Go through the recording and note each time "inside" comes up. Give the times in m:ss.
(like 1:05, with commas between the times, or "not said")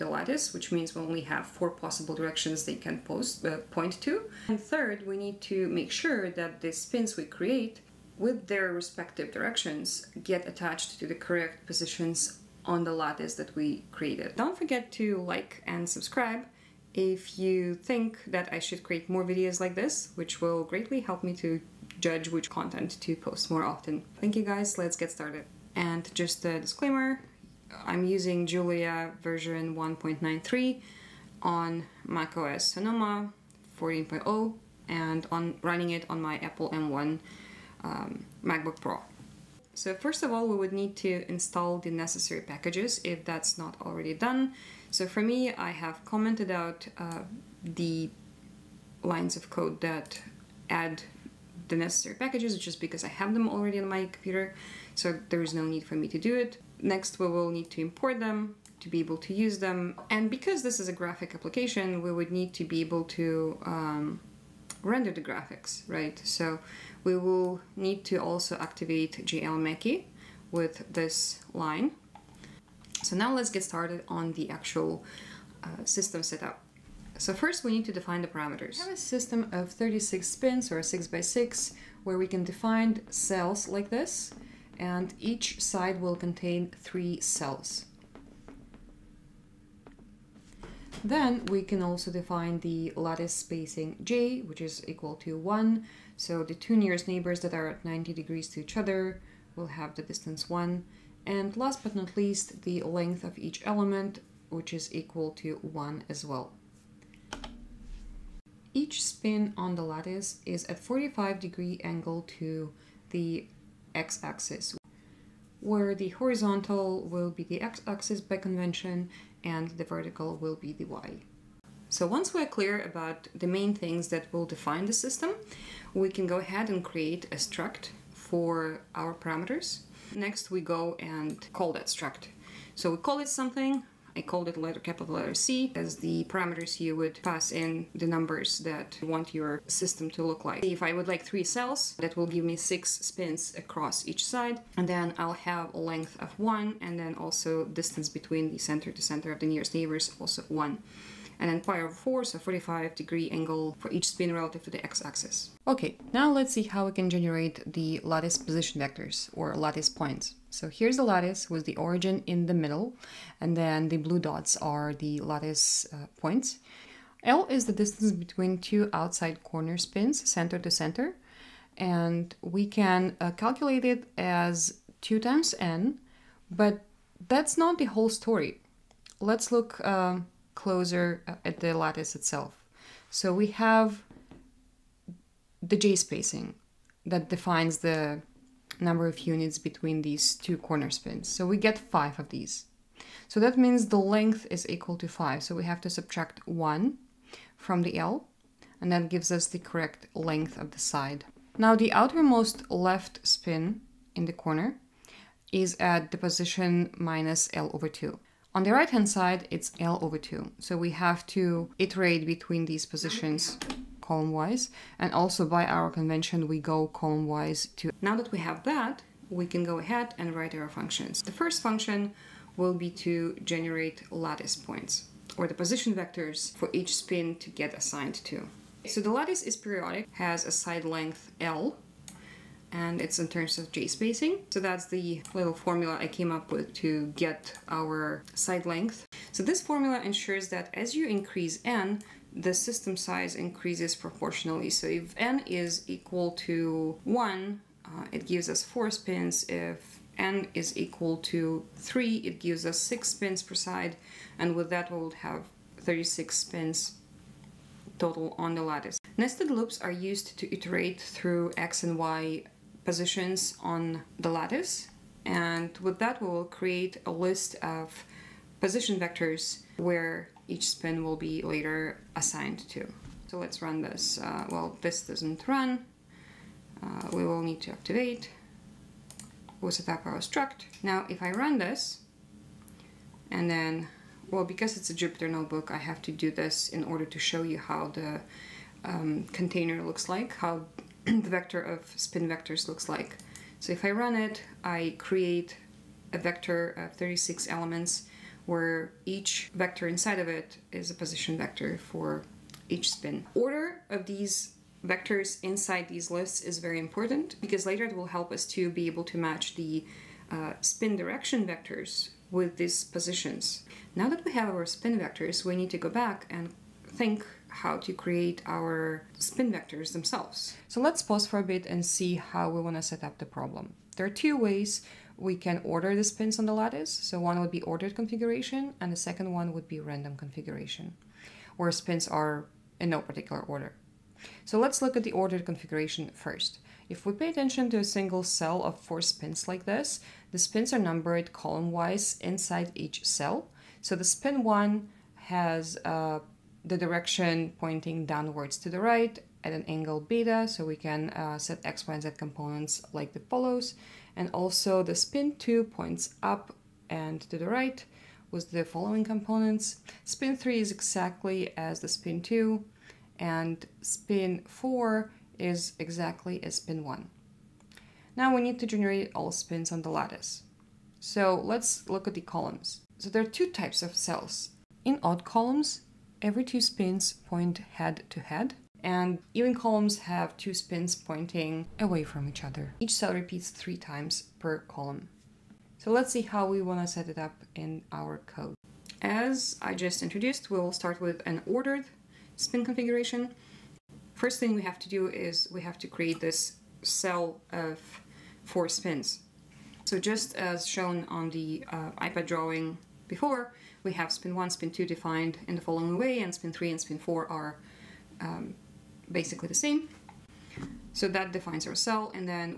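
4:59, 5:05, 5:42.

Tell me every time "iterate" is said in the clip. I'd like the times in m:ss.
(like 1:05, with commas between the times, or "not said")
3:31, 4:20.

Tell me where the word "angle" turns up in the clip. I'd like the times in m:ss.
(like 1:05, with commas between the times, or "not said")
1:51, 2:33, 5:49.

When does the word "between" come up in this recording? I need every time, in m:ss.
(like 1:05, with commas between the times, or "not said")
2:28, 2:48, 3:09, 3:32.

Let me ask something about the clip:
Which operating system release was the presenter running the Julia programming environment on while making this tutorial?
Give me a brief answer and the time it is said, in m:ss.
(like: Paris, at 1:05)
macOS Sonoma 14.0, at 0:32.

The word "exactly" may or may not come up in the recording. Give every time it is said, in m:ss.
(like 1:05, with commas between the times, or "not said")
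6:00, 6:05.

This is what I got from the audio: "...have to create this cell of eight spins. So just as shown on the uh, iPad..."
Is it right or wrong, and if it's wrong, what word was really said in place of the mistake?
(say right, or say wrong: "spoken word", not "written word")
wrong: "four", not "eight".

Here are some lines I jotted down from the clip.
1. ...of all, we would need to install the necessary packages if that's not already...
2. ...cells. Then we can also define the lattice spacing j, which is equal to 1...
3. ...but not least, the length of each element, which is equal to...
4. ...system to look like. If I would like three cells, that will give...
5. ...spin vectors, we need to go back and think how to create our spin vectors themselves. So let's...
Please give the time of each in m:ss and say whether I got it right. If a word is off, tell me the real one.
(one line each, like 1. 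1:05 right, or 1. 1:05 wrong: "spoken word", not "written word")
1. 0:40 right
2. 1:27 right
3. 1:41 right
4. 2:19 right
5. 5:14 right.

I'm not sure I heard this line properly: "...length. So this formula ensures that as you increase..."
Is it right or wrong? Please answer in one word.
right.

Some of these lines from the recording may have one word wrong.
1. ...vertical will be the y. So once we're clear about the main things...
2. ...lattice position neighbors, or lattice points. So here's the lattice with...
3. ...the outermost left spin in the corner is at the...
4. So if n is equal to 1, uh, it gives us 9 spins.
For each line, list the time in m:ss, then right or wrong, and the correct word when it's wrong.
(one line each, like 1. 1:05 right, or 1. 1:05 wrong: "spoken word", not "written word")
1. 1:59 right
2. 2:38 wrong: "vectors", not "neighbors"
3. 3:21 right
4. 4:04 wrong: "4", not "9".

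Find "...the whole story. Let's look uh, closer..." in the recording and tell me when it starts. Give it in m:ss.
2:57.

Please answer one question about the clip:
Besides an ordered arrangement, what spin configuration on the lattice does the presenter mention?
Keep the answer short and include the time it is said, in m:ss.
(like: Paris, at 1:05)
random configuration, at 5:29.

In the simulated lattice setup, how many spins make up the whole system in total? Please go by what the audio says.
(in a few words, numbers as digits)
36.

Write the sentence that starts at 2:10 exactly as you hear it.
Next, we go and call that struct.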